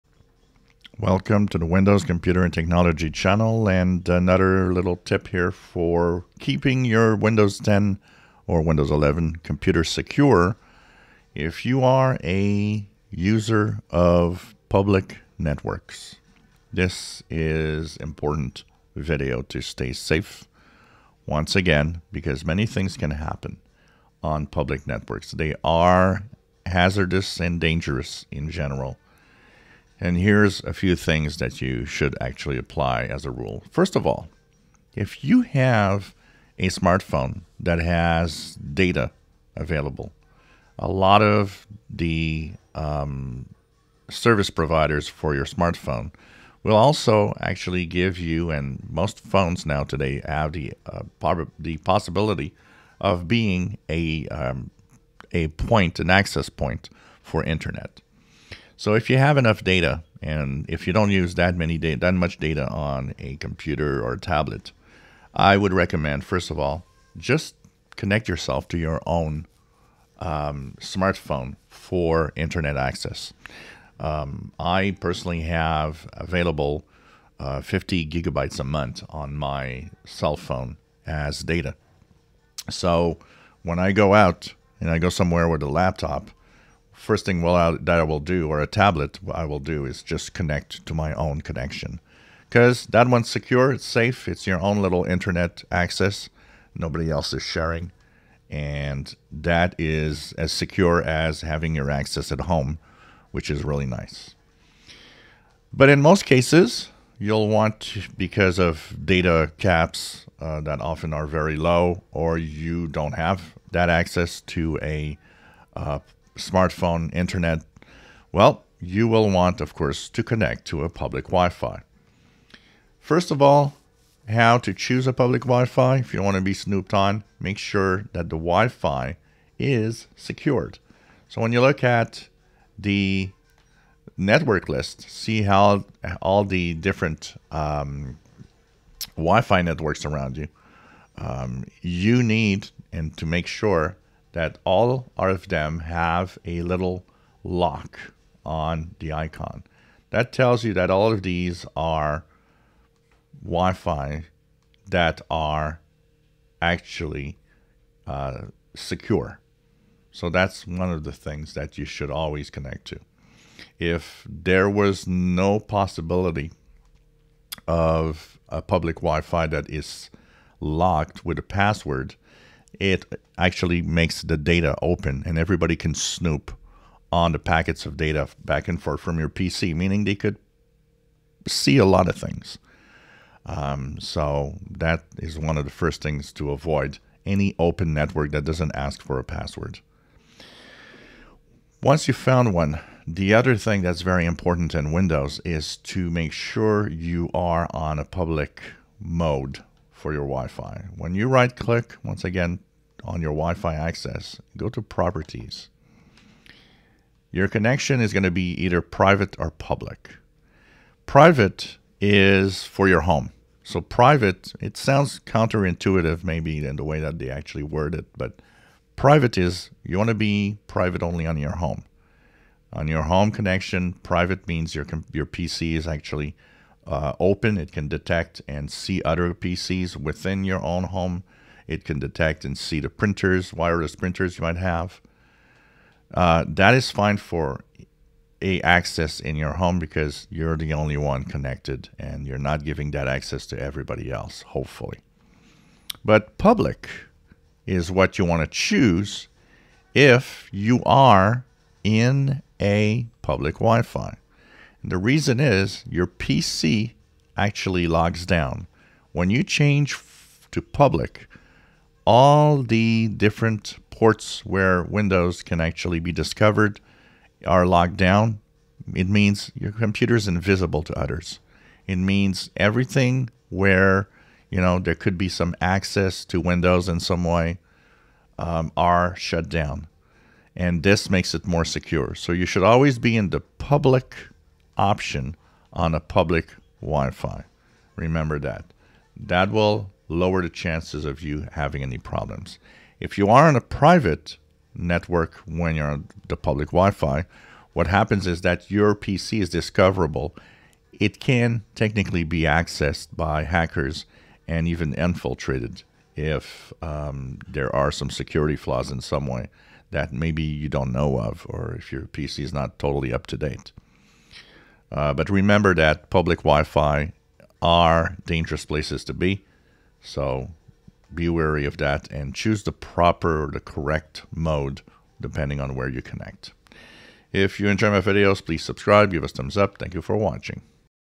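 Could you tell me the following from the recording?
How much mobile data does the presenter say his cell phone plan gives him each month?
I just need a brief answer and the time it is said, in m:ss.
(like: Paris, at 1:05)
50 gigabytes, at 1:17.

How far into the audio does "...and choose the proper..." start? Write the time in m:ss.
5:22.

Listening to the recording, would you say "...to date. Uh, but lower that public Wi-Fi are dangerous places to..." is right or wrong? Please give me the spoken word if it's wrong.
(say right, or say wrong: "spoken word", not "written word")
wrong: "remember", not "lower".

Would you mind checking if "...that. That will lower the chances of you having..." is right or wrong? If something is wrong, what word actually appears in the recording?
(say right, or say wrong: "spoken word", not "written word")
right.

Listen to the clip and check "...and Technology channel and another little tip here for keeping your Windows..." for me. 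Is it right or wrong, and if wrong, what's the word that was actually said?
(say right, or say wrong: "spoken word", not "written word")
right.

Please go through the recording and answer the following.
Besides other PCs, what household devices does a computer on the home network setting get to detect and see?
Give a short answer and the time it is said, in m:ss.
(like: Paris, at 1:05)
wireless printers, at 3:53.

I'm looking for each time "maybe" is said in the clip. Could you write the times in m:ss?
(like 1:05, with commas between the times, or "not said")
3:36, 5:10.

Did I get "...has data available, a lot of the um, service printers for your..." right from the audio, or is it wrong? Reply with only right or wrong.
wrong.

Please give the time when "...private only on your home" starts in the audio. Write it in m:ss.
3:40.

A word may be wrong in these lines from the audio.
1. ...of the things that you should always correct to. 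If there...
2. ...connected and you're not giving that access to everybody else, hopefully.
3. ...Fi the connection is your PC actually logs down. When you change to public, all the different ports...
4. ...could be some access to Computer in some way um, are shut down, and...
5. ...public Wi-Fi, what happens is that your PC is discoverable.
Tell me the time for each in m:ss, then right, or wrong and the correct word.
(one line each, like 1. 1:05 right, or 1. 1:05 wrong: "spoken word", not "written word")
1. 2:40 wrong: "connect", not "correct"
2. 4:01 right
3. 4:13 wrong: "reason", not "connection"
4. 4:34 wrong: "Windows", not "Computer"
5. 4:56 right.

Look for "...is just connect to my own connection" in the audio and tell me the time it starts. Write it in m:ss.
1:29.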